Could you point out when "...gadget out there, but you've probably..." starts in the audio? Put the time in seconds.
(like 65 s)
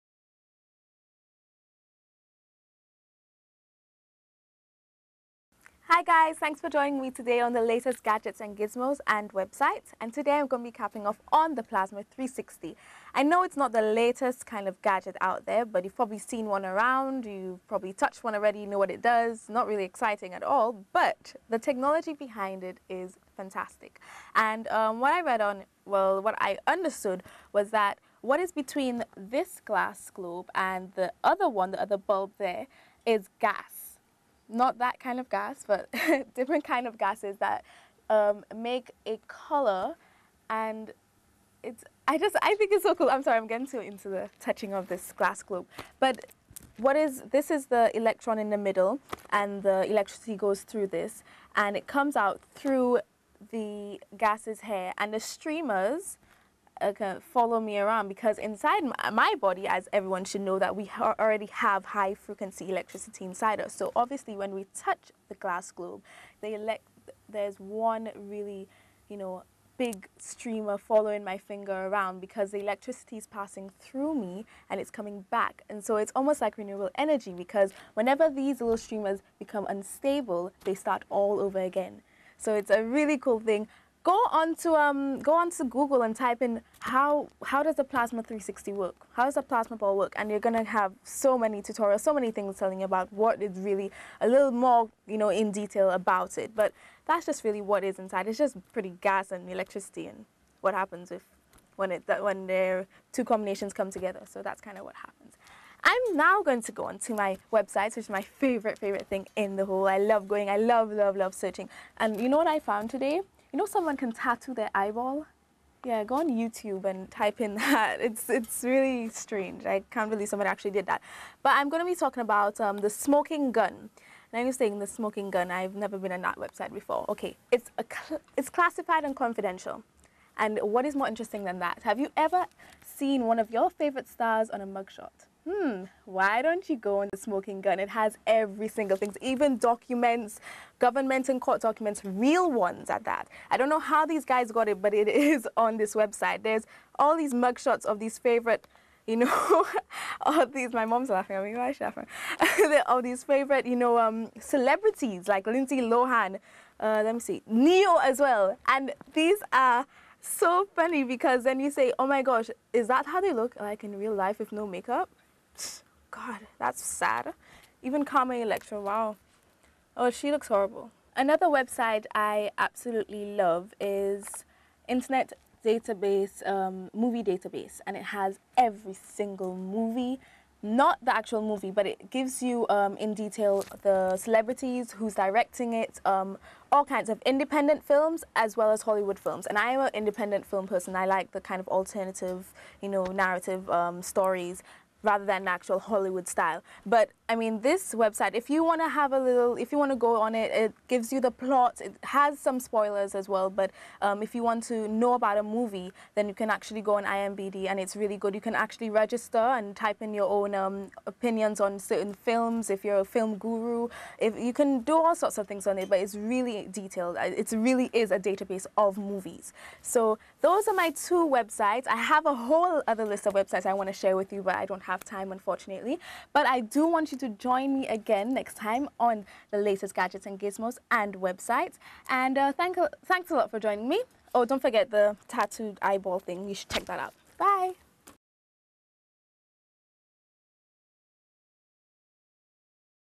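14 s.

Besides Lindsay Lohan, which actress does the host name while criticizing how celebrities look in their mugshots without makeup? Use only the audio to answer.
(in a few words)
Carmen Electra.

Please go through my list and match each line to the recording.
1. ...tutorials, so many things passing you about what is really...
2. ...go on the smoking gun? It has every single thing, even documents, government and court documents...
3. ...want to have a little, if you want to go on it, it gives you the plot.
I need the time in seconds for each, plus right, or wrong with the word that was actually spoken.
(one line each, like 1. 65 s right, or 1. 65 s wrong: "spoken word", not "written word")
1. 91 s wrong: "telling", not "passing"
2. 136 s right
3. 198 s right.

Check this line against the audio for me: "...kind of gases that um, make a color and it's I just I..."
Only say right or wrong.
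right.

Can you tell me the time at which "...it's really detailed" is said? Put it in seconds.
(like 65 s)
215 s.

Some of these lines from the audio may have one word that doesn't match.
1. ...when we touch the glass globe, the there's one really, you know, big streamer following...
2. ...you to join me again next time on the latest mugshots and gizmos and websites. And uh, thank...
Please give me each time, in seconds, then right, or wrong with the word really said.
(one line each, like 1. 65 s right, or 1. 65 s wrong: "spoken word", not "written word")
1. 64 s right
2. 227 s wrong: "gadgets", not "mugshots".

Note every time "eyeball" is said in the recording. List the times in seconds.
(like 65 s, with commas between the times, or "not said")
114 s, 235 s.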